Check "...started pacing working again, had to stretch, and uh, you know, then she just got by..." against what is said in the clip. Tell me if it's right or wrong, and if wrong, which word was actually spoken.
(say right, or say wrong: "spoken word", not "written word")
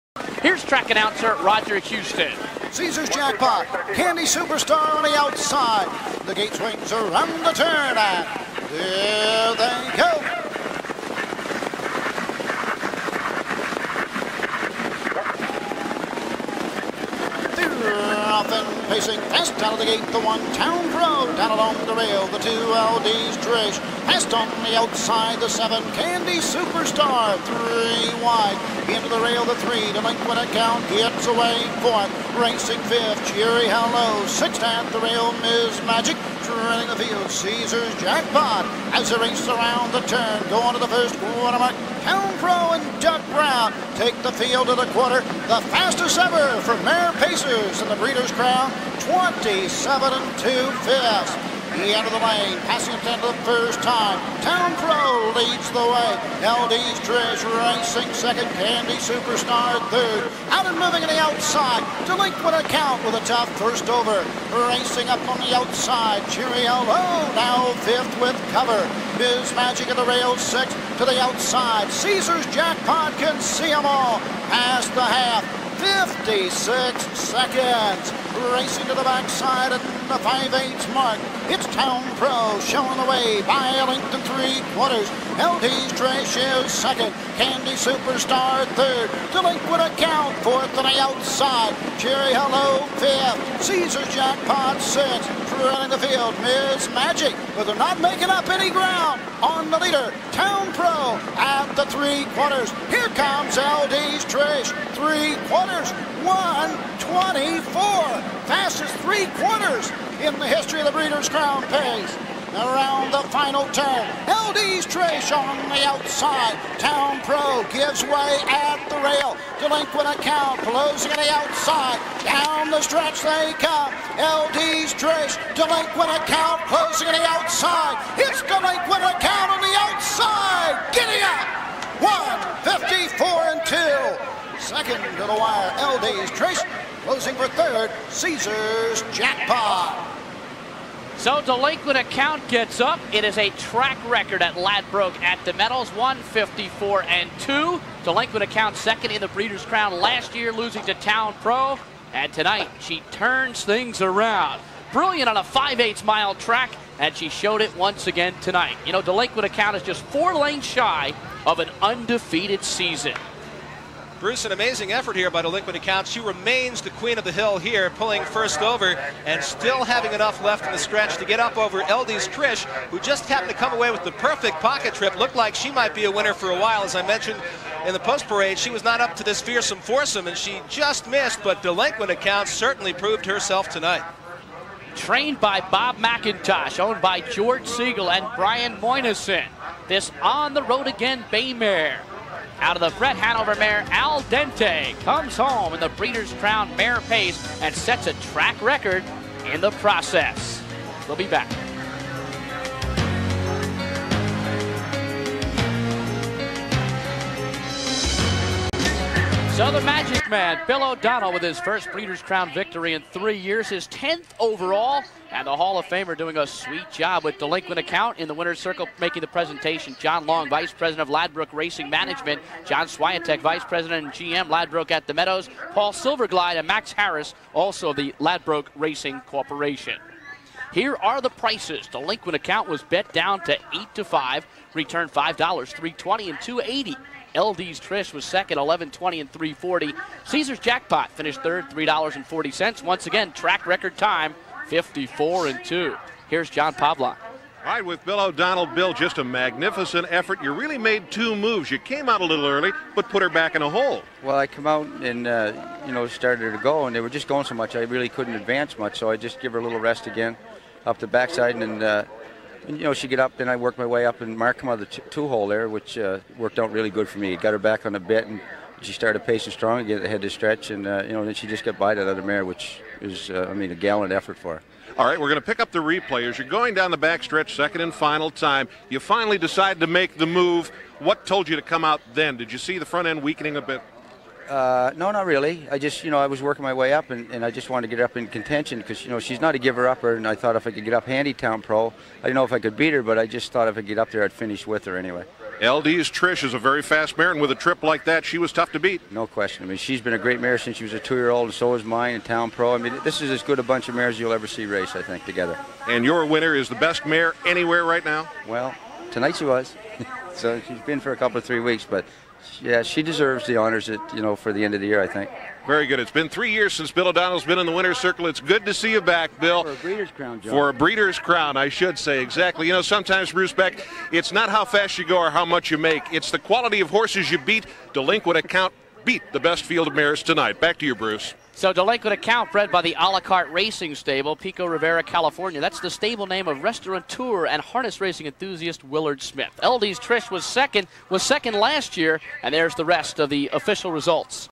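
wrong: "strong", not "working".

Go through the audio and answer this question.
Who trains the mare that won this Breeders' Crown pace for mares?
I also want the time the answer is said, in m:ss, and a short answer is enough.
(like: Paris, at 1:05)
Bob McIntosh, at 3:05.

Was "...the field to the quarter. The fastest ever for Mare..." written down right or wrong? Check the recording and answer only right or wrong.
right.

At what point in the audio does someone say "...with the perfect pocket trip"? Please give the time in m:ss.
2:53.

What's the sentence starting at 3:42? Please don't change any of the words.
John Swiatek, Vice President and GM, Ladbroke at the Meadows.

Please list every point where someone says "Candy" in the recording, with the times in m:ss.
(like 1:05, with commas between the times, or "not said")
0:03, 0:25, 0:58, 1:27.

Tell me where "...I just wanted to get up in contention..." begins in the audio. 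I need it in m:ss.
4:47.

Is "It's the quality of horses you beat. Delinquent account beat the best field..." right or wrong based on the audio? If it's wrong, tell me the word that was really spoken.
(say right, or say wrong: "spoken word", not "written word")
right.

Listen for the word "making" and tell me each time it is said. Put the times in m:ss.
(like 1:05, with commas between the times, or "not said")
1:38, 3:38.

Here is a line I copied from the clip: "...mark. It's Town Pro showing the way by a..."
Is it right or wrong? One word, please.
right.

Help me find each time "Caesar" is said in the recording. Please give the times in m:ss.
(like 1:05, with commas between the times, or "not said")
0:02, 0:37, 1:11, 1:33, 2:18, 4:00.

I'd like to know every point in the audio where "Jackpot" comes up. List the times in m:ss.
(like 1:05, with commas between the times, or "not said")
0:03, 0:37, 1:12, 1:34, 2:19, 4:00.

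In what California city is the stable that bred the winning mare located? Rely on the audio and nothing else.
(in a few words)
Pico Rivera.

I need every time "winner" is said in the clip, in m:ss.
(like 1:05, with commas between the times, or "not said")
2:56, 3:38, 5:06, 5:17.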